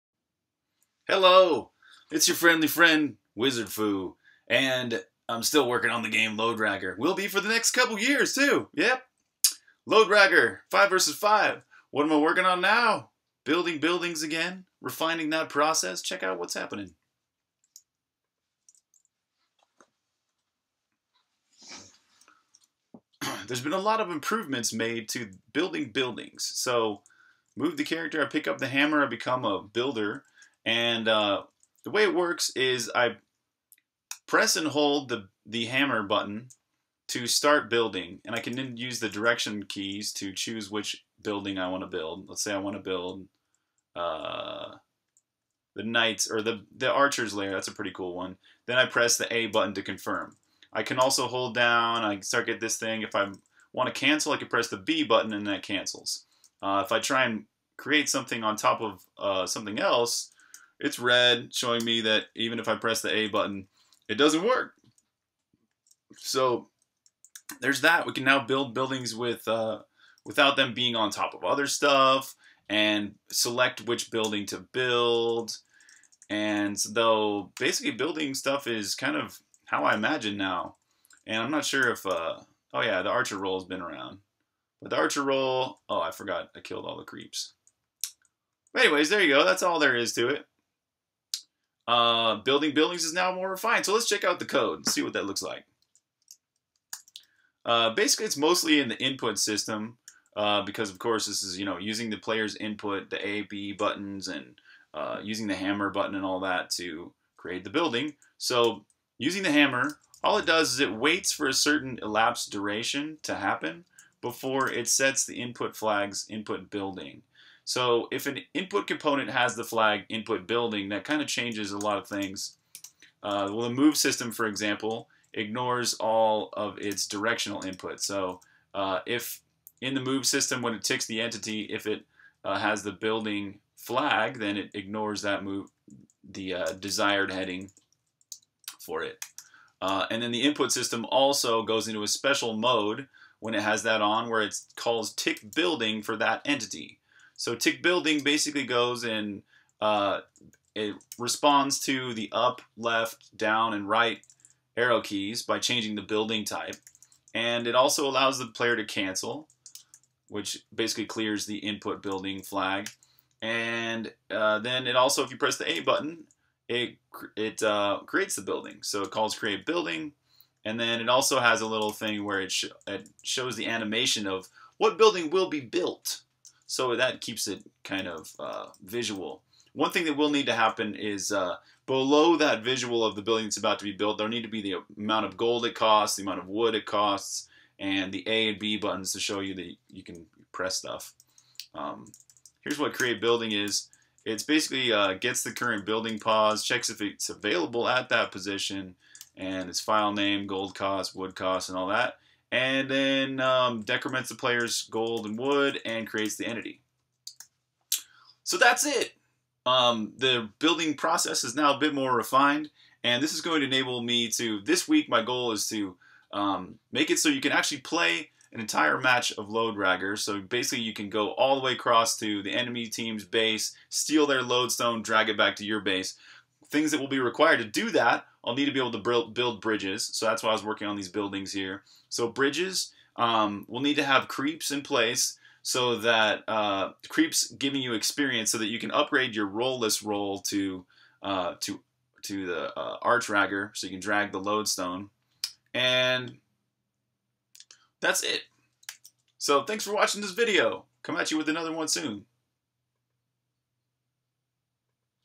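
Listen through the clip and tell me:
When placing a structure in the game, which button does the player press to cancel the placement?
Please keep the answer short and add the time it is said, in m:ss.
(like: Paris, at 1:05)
B button, at 0:54.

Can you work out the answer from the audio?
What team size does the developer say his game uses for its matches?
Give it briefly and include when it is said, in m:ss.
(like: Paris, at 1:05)
5 versus 5, at 0:10.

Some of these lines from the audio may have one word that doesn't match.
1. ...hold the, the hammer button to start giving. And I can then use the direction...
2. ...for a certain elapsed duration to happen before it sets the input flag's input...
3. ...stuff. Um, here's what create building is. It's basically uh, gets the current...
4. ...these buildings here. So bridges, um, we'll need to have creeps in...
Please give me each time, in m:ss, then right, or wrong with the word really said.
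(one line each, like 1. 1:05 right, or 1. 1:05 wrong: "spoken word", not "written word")
1. 0:34 wrong: "building", not "giving"
2. 1:51 right
3. 3:10 right
4. 3:50 right.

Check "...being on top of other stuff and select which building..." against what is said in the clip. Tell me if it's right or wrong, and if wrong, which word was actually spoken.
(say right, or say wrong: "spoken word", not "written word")
right.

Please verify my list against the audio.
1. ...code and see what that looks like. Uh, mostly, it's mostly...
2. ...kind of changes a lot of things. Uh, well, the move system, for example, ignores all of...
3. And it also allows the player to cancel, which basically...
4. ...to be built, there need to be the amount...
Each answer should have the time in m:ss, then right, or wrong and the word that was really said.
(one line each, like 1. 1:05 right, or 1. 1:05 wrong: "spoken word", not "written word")
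1. 1:34 wrong: "basically", not "mostly"
2. 2:01 right
3. 2:37 right
4. 3:03 right.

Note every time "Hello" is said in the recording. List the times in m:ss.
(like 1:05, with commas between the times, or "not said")
0:01.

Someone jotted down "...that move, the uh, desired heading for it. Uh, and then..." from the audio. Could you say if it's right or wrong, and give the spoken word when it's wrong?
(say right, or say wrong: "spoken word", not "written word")
right.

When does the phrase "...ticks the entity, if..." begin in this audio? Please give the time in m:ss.
2:10.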